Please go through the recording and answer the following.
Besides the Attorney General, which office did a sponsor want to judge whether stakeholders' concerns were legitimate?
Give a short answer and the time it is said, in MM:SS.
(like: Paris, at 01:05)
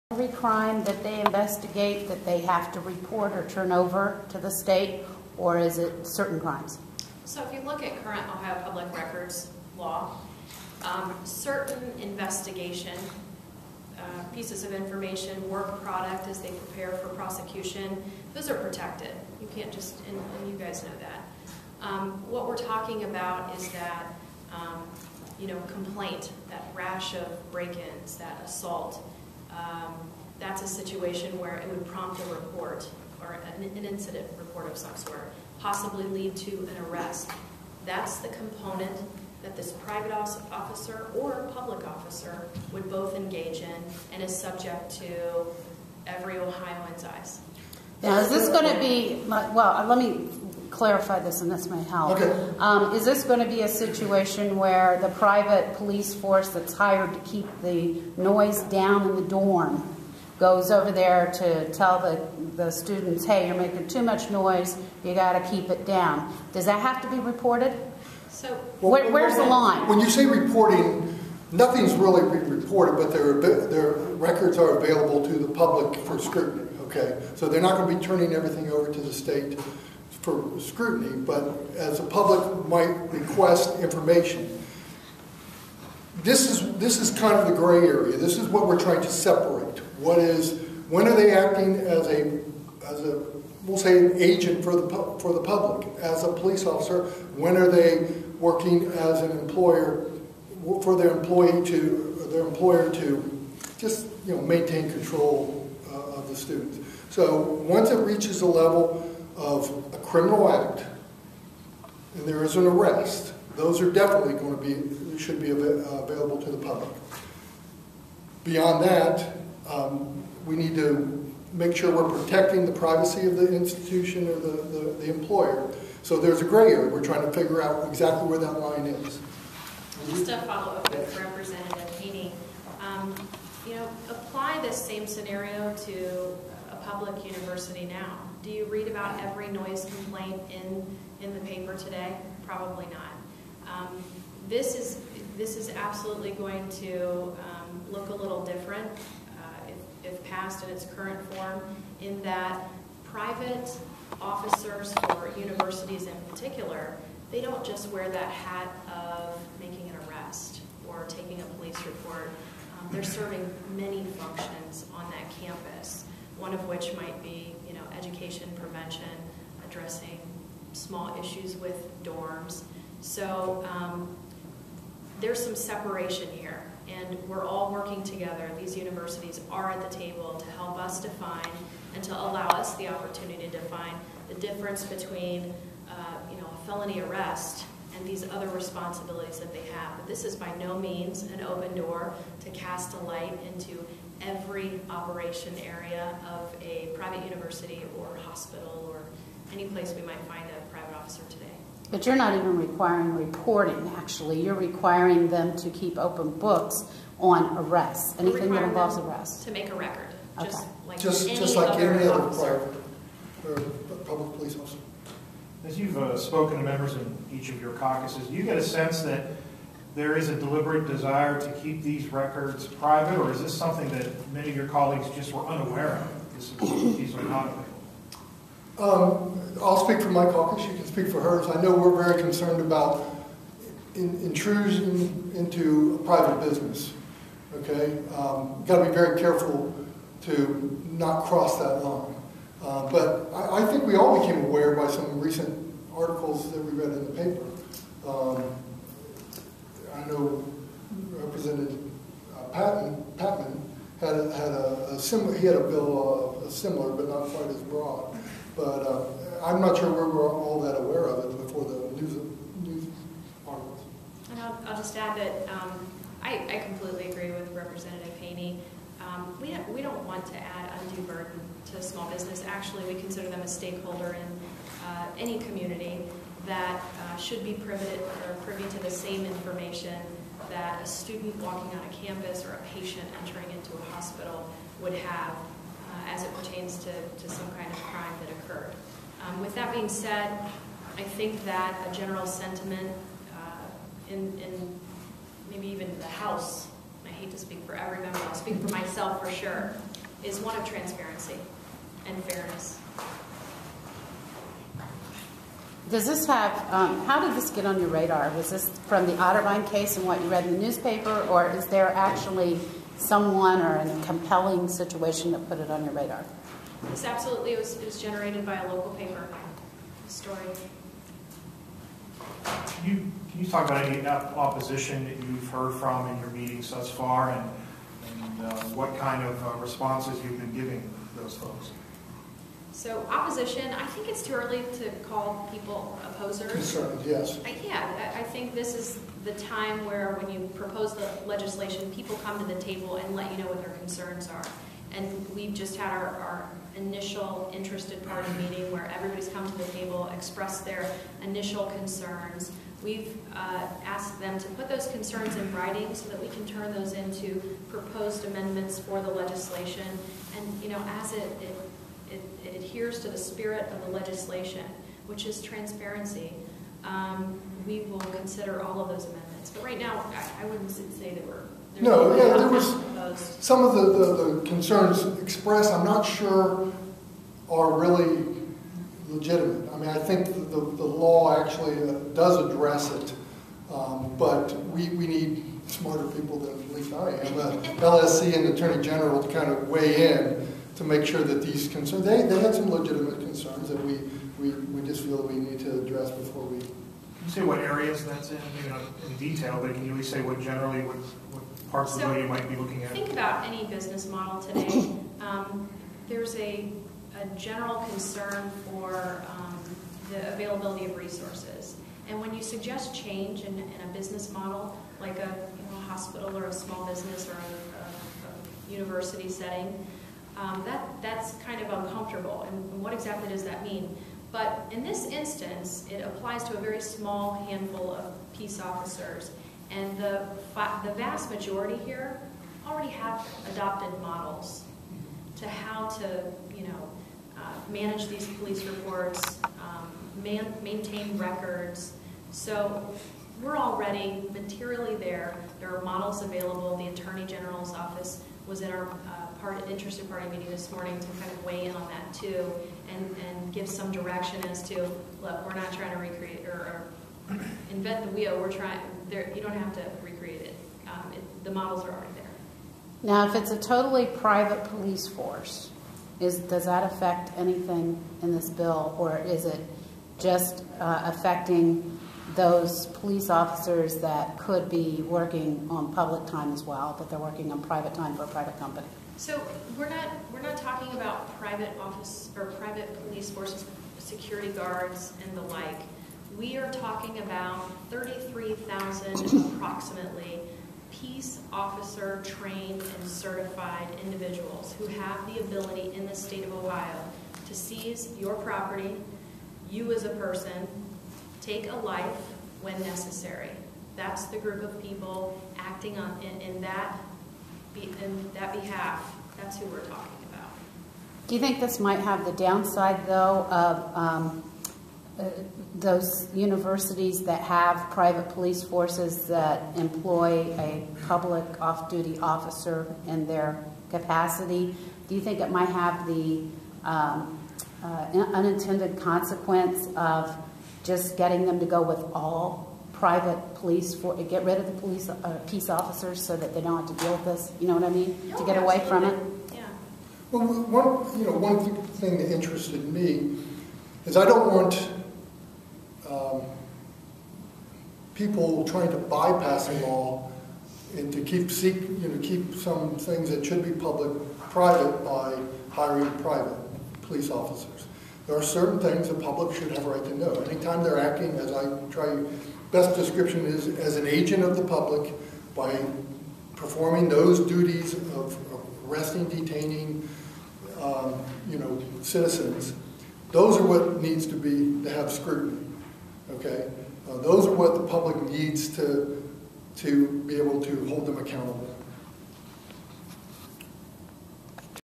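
LSC, at 06:27.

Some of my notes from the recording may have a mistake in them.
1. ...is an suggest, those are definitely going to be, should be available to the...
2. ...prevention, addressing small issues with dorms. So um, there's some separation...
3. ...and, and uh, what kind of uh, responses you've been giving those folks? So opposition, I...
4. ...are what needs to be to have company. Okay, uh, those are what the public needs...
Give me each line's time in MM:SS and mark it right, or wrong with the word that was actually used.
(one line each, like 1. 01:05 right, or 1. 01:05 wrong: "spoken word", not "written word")
1. 01:52 wrong: "arrest", not "suggest"
2. 02:48 right
3. 05:27 right
4. 09:33 wrong: "scrutiny", not "company".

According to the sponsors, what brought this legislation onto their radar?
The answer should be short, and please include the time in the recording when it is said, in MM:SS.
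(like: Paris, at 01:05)
A local paper story, at 05:18.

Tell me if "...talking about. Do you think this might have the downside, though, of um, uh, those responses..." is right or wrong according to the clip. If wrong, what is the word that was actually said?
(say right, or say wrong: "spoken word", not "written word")
wrong: "universities", not "responses".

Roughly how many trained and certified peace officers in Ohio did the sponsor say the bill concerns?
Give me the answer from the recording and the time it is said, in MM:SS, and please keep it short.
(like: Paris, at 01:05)
33,000, at 08:07.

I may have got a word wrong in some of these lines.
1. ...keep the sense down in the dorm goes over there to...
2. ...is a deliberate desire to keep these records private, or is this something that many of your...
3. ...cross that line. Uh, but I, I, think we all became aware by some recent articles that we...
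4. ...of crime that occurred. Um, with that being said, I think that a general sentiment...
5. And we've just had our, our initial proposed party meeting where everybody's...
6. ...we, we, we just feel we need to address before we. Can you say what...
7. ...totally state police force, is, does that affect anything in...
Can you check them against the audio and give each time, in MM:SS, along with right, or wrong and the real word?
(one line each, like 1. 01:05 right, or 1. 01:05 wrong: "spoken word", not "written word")
1. 00:57 wrong: "noise", not "sense"
2. 03:40 right
3. 04:01 right
4. 04:47 right
5. 05:44 wrong: "interested", not "proposed"
6. 06:33 right
7. 07:43 wrong: "private", not "state".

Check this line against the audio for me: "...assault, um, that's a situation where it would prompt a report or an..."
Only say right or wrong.
right.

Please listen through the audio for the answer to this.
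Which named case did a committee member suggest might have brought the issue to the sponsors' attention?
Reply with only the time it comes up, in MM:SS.
05:09.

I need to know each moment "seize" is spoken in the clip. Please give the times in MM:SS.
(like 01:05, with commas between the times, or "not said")
08:17.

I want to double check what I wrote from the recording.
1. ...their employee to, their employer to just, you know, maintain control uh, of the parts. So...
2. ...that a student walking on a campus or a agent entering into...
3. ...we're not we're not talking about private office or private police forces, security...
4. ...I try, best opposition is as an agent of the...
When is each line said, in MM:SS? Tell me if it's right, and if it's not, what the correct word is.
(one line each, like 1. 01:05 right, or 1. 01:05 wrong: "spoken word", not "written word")
1. 01:40 wrong: "students", not "parts"
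2. 04:40 wrong: "patient", not "agent"
3. 07:59 right
4. 09:21 wrong: "description", not "opposition".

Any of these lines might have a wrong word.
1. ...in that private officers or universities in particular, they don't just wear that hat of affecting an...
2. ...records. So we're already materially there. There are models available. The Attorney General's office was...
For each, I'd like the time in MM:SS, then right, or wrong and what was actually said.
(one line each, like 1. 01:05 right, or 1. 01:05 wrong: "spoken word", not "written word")
1. 02:32 wrong: "making", not "affecting"
2. 07:21 right.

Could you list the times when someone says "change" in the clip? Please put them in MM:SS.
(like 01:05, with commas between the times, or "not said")
06:52.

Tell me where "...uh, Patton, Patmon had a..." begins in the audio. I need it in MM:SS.
04:12.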